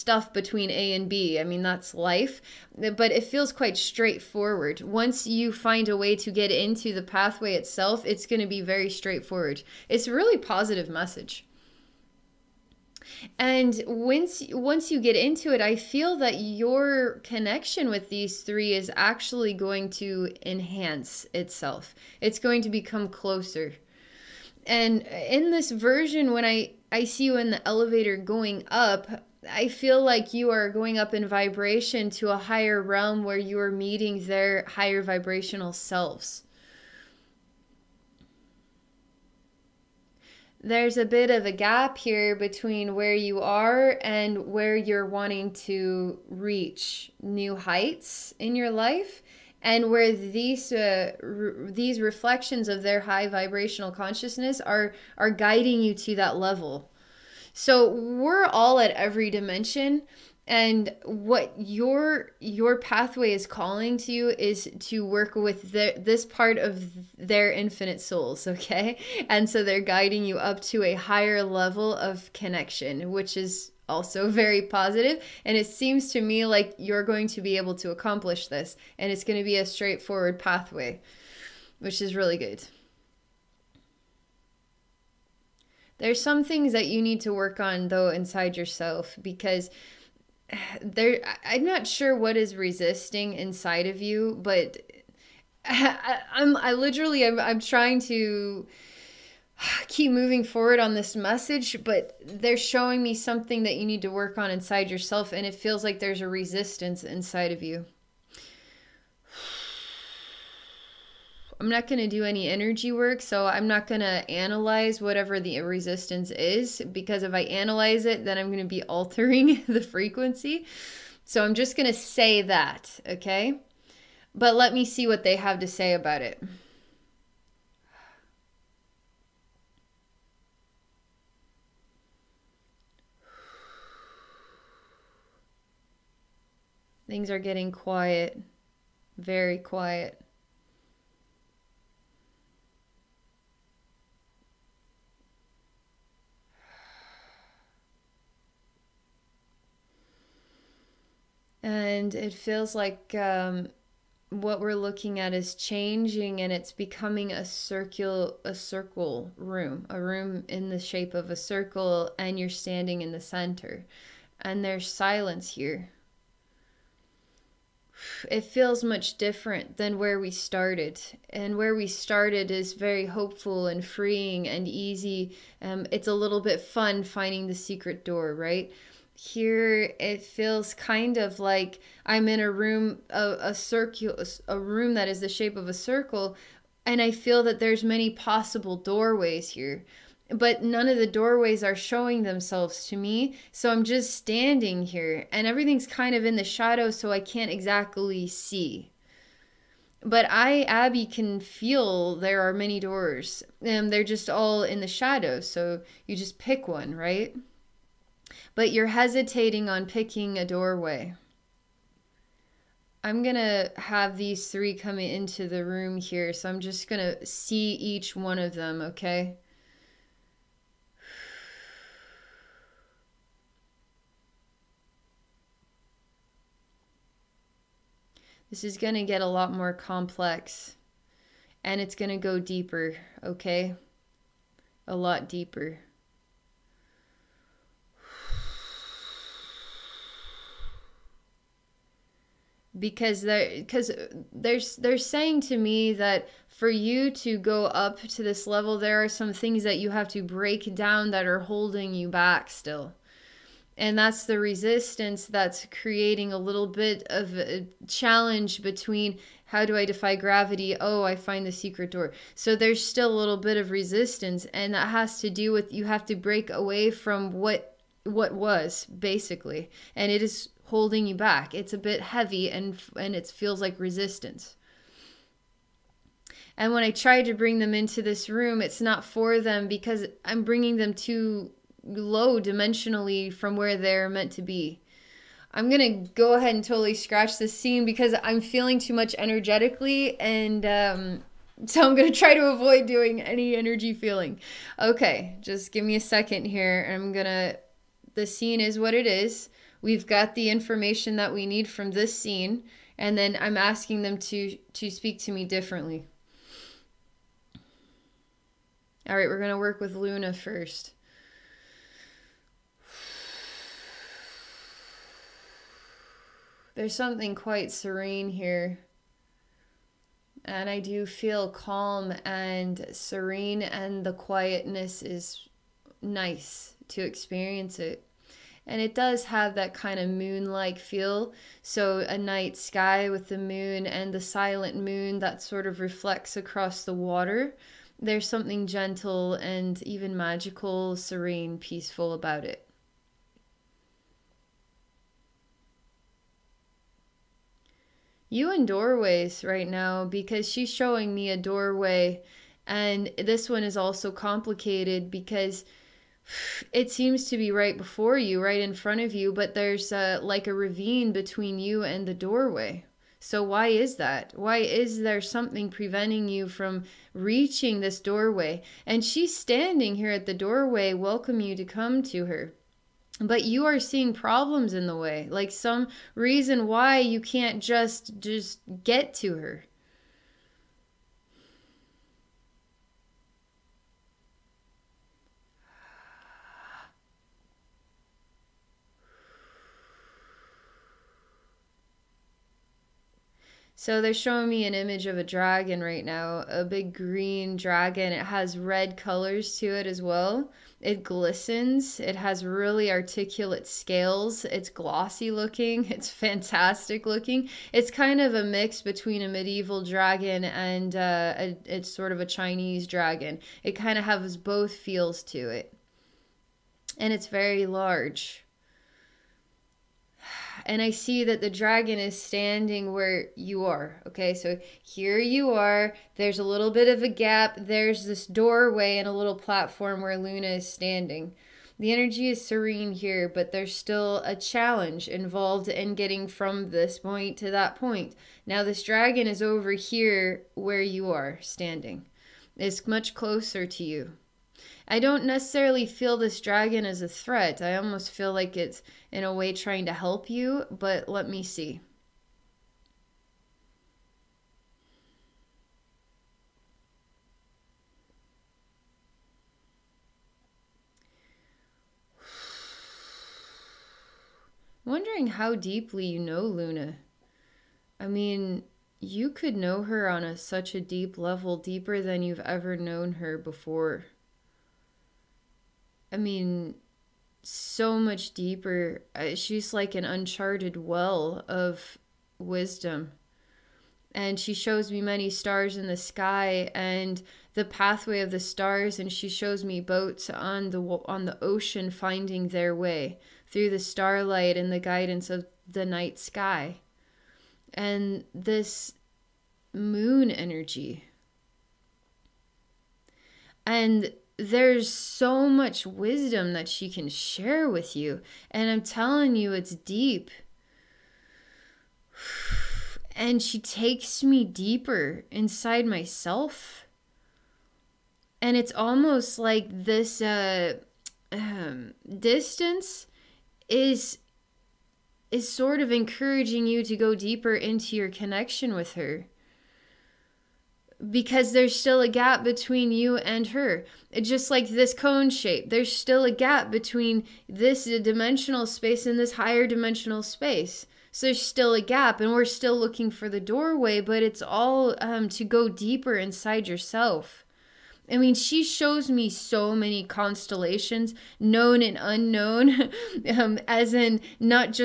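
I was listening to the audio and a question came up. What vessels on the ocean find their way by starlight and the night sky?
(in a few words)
boats.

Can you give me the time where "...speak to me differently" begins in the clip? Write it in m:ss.
5:04.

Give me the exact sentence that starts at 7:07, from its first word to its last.
There's this doorway and a little platform where Luna is standing.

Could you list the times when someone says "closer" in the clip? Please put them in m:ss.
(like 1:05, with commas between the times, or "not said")
0:23, 7:23.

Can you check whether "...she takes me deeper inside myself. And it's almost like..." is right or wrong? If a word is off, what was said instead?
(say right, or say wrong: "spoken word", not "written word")
right.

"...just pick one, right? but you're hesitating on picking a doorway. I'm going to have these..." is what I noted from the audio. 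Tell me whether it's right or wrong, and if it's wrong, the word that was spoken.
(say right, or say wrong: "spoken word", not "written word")
right.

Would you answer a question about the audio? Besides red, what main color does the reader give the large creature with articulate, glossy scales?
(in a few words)
green.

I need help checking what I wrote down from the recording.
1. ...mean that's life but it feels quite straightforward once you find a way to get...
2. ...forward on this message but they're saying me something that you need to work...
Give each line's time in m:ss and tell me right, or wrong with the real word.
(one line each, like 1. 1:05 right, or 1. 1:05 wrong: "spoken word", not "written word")
1. 0:01 right
2. 1:40 wrong: "showing", not "saying".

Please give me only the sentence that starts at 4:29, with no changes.
And it is holding you back.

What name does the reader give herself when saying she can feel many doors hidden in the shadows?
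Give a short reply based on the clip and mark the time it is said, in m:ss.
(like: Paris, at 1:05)
Abbey, at 3:20.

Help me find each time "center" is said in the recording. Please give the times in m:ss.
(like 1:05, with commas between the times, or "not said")
2:43.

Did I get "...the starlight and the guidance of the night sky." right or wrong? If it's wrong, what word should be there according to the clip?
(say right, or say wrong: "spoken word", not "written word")
right.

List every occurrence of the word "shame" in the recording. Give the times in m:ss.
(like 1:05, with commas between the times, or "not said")
not said.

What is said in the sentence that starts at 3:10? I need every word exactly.
But none of the doorways are showing themselves to me.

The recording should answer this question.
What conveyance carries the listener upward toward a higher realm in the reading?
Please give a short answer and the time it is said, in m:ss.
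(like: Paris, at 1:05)
elevator, at 0:27.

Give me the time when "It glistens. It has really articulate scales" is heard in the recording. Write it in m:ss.
6:40.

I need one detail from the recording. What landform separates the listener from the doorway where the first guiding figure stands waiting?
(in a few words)
ravine.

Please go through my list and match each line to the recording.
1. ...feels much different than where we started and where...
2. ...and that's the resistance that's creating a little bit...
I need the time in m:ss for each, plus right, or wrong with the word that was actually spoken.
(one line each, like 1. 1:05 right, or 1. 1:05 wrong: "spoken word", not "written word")
1. 2:48 right
2. 4:13 right.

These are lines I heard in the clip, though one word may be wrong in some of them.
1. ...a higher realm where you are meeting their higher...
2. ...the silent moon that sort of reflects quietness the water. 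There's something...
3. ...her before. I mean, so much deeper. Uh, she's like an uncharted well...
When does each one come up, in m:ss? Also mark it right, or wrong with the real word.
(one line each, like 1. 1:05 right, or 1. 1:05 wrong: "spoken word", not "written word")
1. 0:32 right
2. 5:34 wrong: "across", not "quietness"
3. 7:53 right.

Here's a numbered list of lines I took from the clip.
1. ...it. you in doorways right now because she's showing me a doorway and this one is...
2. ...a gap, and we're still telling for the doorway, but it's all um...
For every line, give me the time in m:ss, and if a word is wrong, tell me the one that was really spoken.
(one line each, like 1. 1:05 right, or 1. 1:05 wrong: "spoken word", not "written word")
1. 5:42 right
2. 9:01 wrong: "looking", not "telling".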